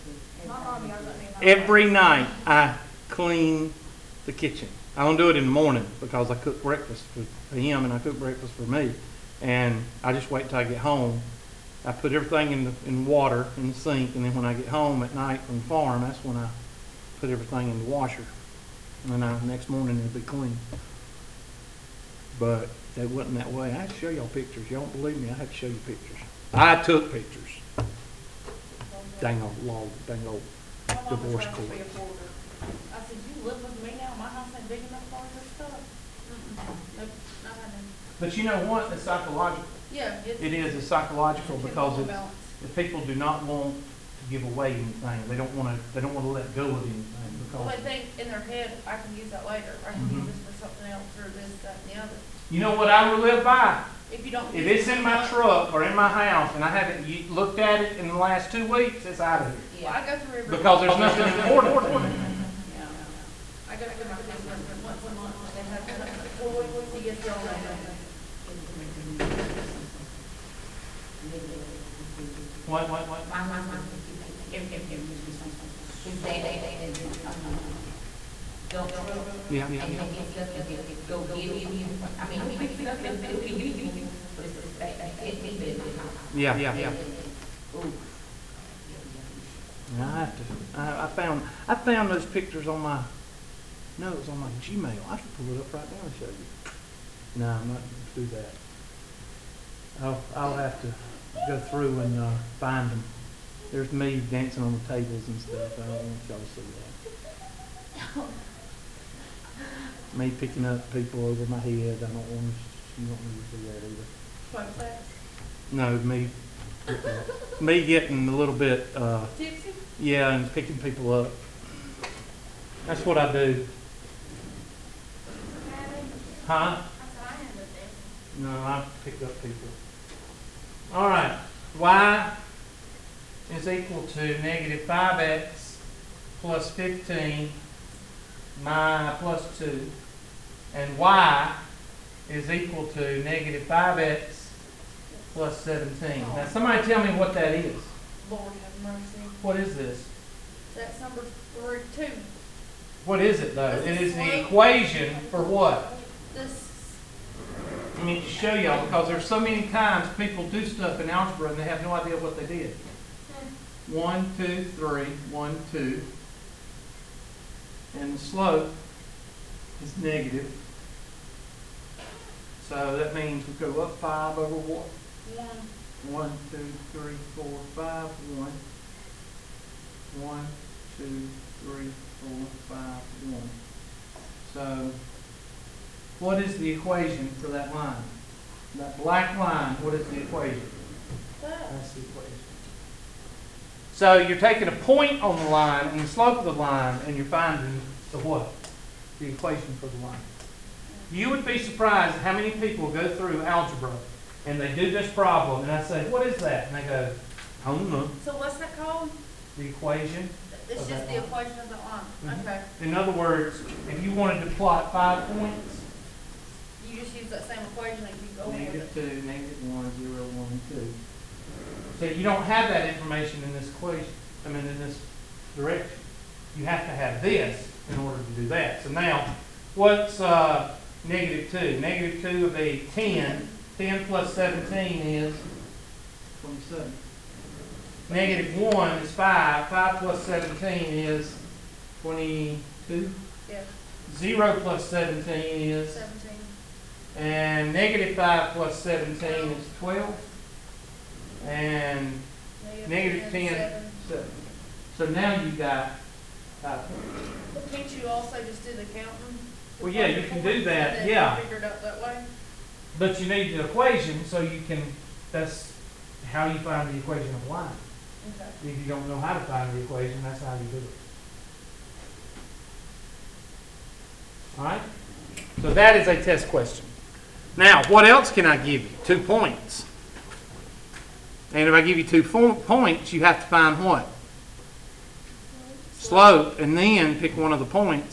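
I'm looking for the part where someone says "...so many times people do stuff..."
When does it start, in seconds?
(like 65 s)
159 s.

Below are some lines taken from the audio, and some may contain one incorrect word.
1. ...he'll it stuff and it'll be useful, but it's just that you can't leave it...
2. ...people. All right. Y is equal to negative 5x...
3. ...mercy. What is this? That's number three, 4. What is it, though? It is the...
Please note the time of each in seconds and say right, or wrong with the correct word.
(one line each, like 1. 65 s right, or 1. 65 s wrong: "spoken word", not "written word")
1. 82 s right
2. 129 s right
3. 148 s wrong: "2", not "4".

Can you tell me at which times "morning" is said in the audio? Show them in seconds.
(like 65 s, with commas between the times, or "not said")
5 s, 19 s.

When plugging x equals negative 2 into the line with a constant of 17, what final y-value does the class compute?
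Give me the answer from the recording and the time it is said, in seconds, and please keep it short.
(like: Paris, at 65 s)
27, at 236 s.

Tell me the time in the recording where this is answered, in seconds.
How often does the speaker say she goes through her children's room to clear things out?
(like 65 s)
64 s.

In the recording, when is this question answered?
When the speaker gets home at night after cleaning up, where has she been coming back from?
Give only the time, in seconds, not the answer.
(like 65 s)
15 s.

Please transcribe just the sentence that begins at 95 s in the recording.
I should pull it up right now and show you.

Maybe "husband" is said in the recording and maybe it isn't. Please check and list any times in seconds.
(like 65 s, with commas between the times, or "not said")
73 s.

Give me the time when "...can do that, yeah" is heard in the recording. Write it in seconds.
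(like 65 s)
260 s.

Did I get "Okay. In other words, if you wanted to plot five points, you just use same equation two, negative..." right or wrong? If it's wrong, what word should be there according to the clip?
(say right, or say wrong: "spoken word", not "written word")
right.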